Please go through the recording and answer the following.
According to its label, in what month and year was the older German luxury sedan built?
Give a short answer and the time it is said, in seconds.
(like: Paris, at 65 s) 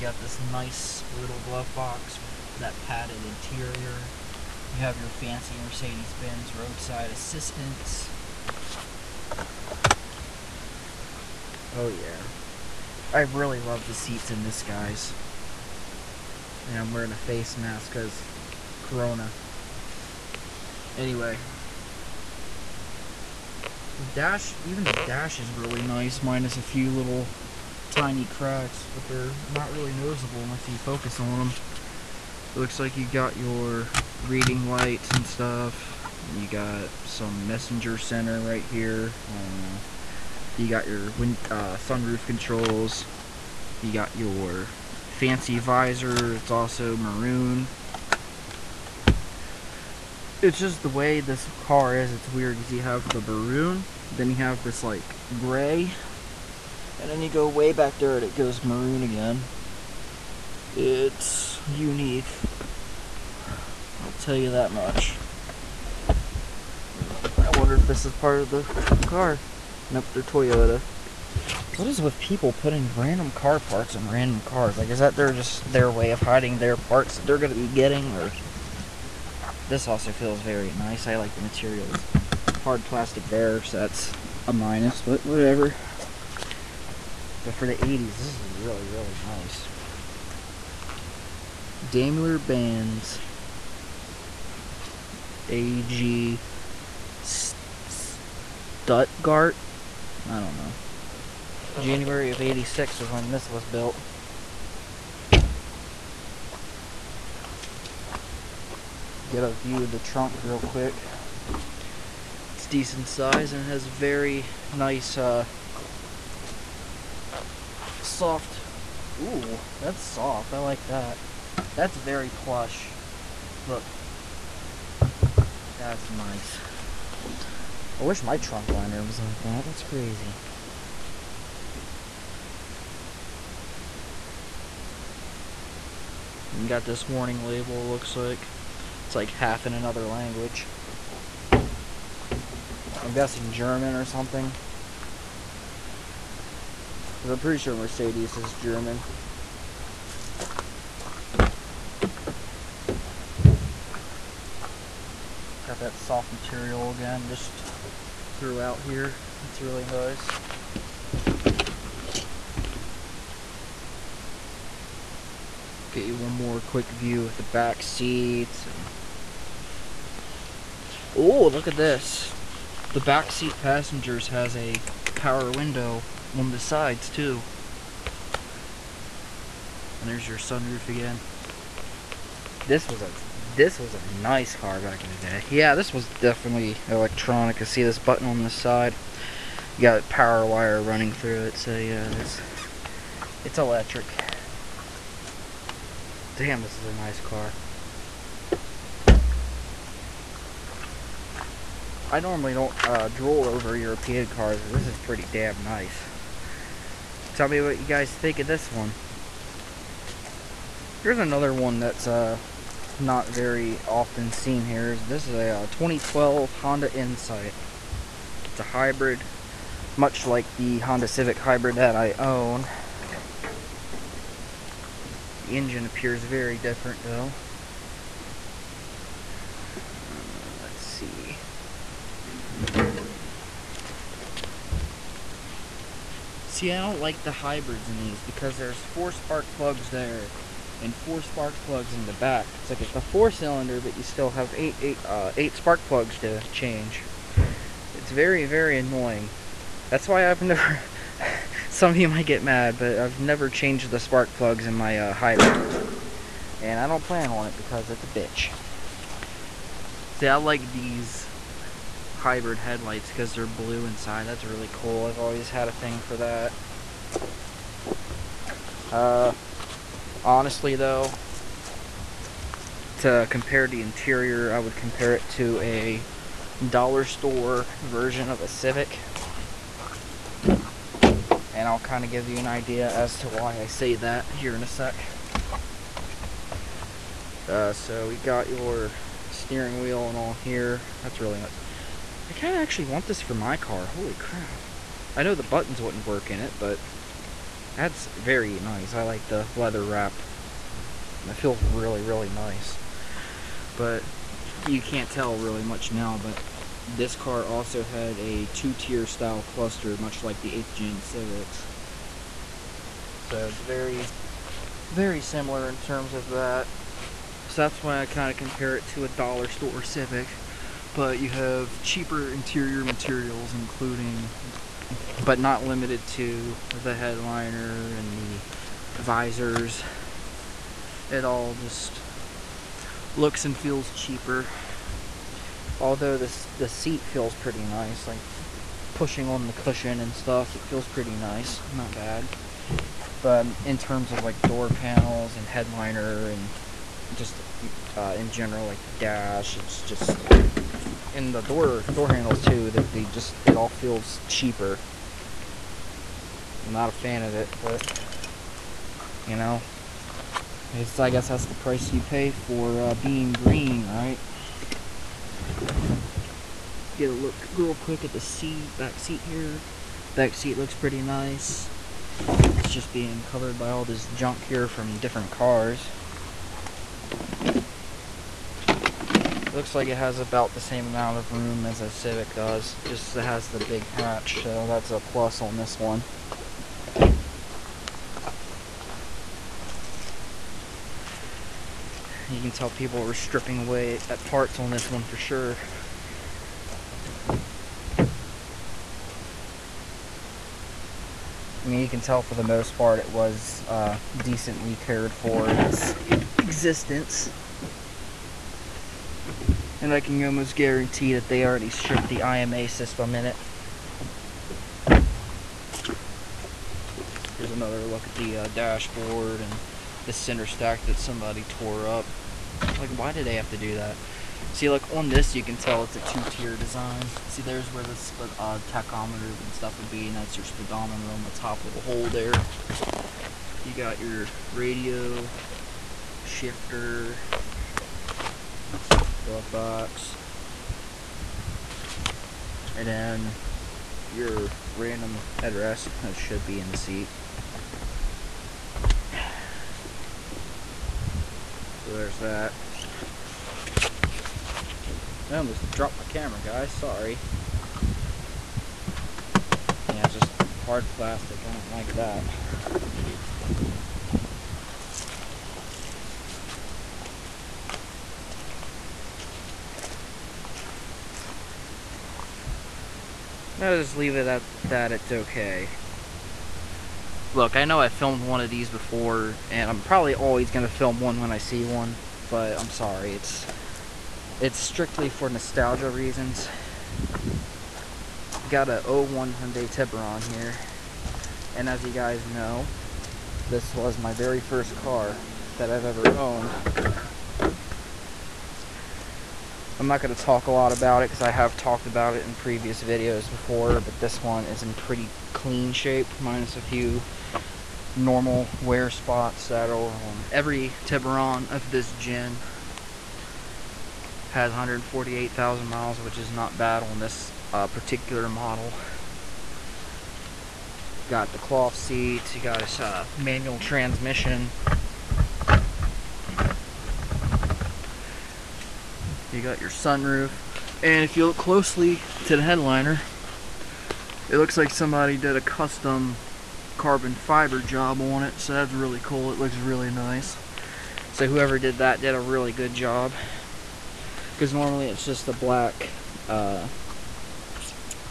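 January 1986, at 101 s.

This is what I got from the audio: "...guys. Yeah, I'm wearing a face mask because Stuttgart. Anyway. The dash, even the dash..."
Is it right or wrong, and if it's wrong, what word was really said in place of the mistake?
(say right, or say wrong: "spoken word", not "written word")
wrong: "Corona", not "Stuttgart".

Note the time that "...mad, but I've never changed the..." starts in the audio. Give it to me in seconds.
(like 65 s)
252 s.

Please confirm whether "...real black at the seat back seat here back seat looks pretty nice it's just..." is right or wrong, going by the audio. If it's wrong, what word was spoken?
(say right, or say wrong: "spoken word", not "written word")
wrong: "quick", not "black".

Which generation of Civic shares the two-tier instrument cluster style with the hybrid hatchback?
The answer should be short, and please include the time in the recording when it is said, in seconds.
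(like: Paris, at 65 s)
8th Gen, at 310 s.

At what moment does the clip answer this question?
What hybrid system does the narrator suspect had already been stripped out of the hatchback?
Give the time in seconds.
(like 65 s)
412 s.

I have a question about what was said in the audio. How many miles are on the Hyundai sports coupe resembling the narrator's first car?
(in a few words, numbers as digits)
148,000.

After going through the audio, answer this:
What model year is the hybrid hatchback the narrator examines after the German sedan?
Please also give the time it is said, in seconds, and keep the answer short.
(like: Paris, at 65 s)
2012, at 215 s.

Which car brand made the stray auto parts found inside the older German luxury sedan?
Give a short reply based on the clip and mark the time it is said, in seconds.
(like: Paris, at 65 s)
Toyota, at 70 s.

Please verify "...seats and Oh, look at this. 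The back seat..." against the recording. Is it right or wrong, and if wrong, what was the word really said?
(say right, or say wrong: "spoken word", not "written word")
right.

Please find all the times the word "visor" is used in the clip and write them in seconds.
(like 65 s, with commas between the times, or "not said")
45 s, 328 s.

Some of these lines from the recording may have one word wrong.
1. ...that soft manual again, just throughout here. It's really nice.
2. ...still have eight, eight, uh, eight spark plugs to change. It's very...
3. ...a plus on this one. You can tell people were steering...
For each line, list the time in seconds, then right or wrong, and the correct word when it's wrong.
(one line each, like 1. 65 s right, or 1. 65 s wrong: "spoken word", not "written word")
1. 155 s wrong: "material", not "manual"
2. 244 s right
3. 384 s wrong: "stripping", not "steering".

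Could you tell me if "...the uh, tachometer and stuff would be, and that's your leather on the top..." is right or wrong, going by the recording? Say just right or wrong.
wrong.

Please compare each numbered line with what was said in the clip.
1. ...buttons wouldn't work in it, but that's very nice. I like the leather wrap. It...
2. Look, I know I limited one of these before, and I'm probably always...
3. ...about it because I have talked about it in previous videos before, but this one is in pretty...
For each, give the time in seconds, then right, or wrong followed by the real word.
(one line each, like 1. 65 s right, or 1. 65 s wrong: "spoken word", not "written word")
1. 295 s right
2. 477 s wrong: "filmed", not "limited"
3. 500 s right.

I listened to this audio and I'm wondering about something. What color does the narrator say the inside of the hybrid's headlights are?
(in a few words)
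blue.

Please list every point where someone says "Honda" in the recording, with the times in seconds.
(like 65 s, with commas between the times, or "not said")
216 s, 220 s.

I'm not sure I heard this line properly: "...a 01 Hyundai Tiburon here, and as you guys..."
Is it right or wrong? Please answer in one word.
right.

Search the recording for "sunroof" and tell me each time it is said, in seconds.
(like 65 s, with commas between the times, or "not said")
41 s, 180 s, 529 s.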